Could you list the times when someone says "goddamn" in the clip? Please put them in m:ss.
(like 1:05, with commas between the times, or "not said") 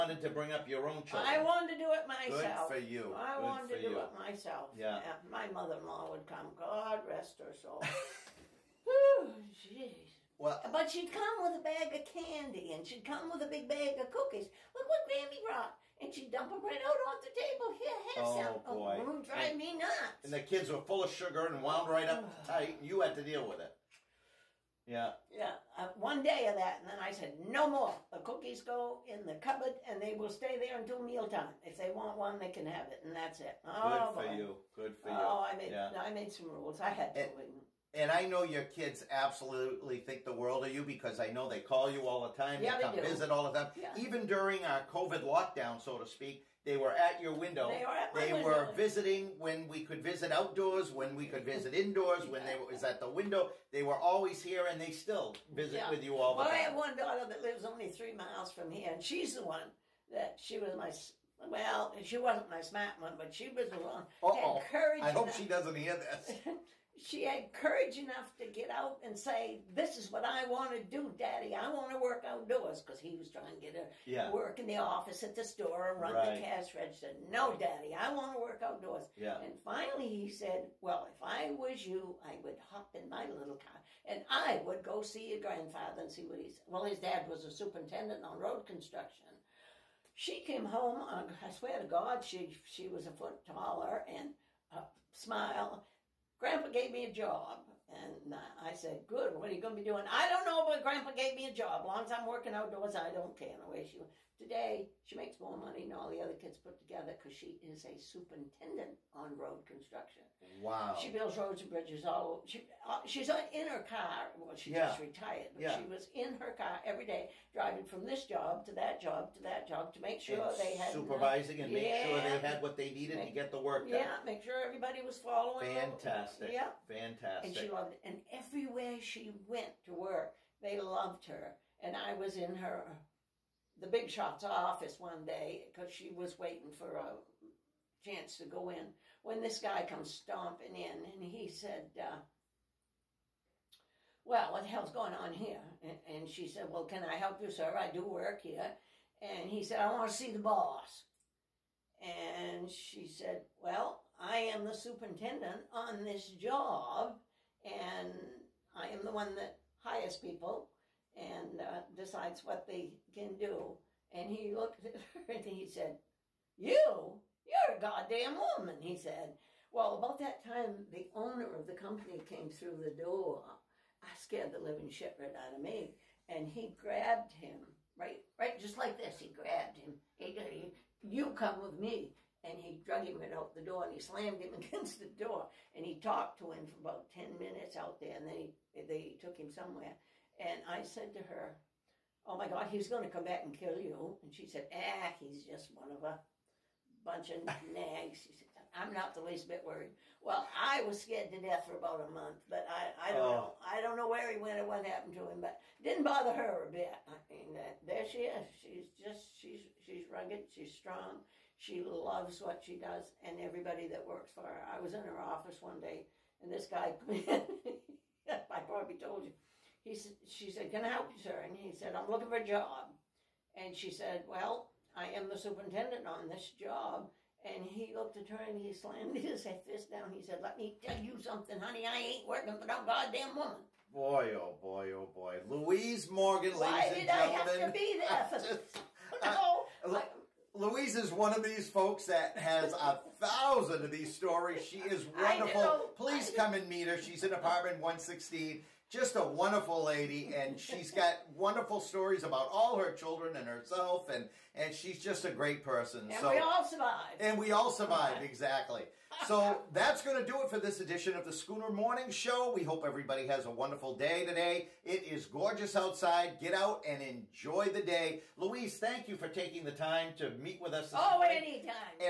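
2:47, 3:52.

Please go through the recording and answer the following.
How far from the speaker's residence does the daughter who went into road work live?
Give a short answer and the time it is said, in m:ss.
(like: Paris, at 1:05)
3 miles, at 0:57.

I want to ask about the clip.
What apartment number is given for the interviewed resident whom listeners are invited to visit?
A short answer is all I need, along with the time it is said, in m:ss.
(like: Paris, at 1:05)
116, at 4:07.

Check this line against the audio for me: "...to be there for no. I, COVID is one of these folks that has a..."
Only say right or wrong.
wrong.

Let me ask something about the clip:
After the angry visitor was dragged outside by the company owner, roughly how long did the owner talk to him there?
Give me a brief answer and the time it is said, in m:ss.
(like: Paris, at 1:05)
About 10 minutes, at 3:06.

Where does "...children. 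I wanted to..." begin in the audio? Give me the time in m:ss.
0:01.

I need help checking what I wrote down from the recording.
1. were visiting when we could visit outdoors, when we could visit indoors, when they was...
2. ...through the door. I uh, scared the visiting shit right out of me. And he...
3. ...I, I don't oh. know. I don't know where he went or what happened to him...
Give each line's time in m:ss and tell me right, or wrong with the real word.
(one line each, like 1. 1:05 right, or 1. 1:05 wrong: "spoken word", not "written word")
1. 0:48 right
2. 2:52 wrong: "living", not "visiting"
3. 3:22 right.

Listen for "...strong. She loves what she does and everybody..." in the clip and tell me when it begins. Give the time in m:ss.
3:30.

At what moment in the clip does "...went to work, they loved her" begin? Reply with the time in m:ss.
2:09.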